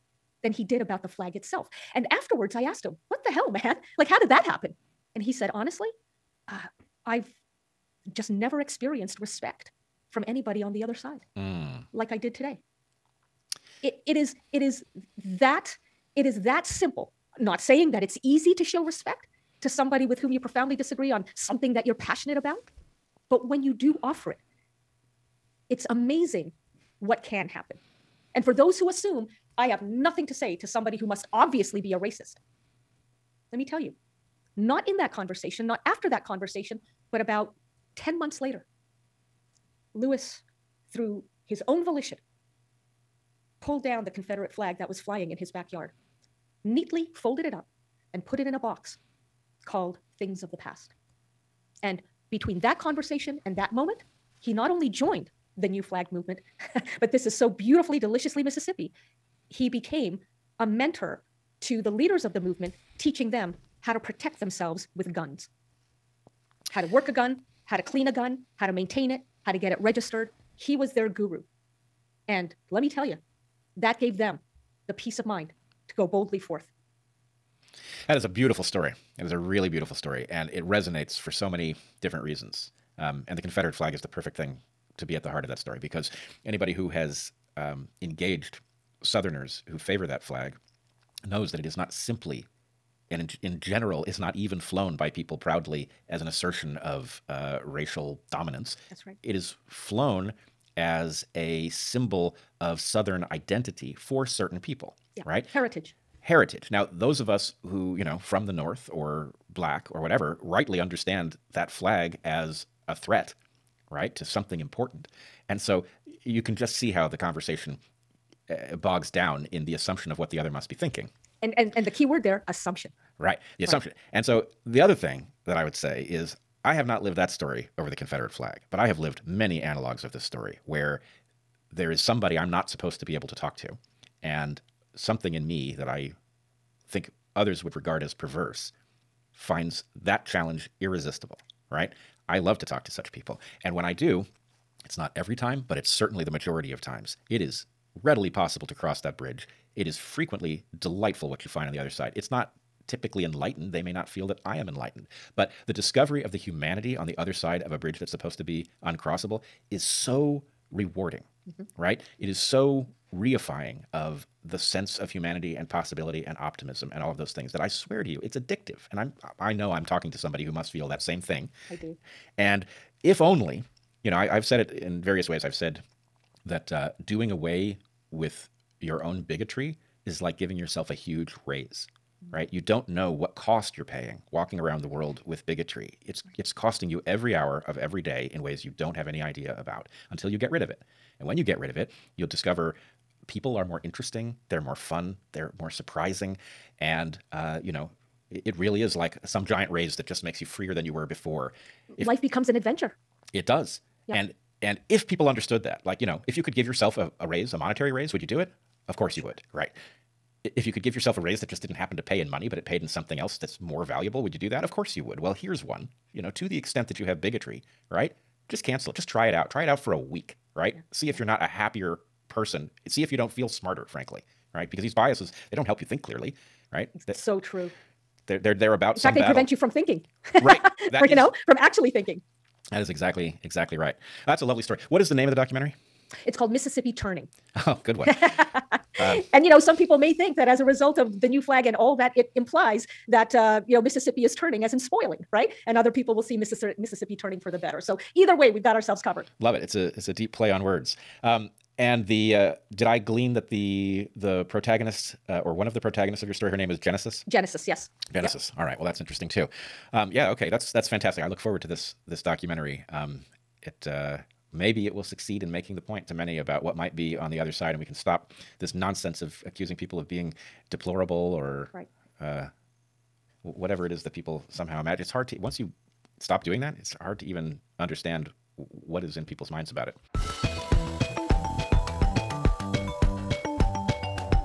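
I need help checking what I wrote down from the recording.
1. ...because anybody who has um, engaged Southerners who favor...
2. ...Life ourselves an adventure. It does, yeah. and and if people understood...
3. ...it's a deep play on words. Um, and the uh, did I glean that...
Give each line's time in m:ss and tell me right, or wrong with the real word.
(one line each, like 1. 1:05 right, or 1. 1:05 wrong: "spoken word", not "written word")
1. 1:25 right
2. 3:22 wrong: "becomes", not "ourselves"
3. 4:09 right.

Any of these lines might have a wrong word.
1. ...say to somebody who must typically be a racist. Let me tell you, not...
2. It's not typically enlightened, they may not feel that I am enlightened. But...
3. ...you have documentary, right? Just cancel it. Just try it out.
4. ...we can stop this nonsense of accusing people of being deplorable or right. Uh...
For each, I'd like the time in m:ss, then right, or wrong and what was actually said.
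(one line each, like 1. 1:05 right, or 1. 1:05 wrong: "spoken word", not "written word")
1. 0:30 wrong: "obviously", not "typically"
2. 2:32 right
3. 3:36 wrong: "bigotry", not "documentary"
4. 4:27 right.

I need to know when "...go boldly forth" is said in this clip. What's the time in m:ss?
1:15.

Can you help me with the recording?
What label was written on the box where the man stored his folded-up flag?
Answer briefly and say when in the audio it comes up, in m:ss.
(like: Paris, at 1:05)
Things of the past, at 0:50.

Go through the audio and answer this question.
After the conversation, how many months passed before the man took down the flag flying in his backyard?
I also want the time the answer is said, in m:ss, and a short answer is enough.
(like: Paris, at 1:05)
10, at 0:37.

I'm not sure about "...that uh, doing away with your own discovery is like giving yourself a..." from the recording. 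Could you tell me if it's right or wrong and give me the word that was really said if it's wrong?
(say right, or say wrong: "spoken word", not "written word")
wrong: "bigotry", not "discovery".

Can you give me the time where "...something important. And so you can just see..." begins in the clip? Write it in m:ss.
1:54.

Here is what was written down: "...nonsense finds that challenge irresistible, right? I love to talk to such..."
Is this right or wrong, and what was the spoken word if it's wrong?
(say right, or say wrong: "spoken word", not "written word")
wrong: "perverse", not "nonsense".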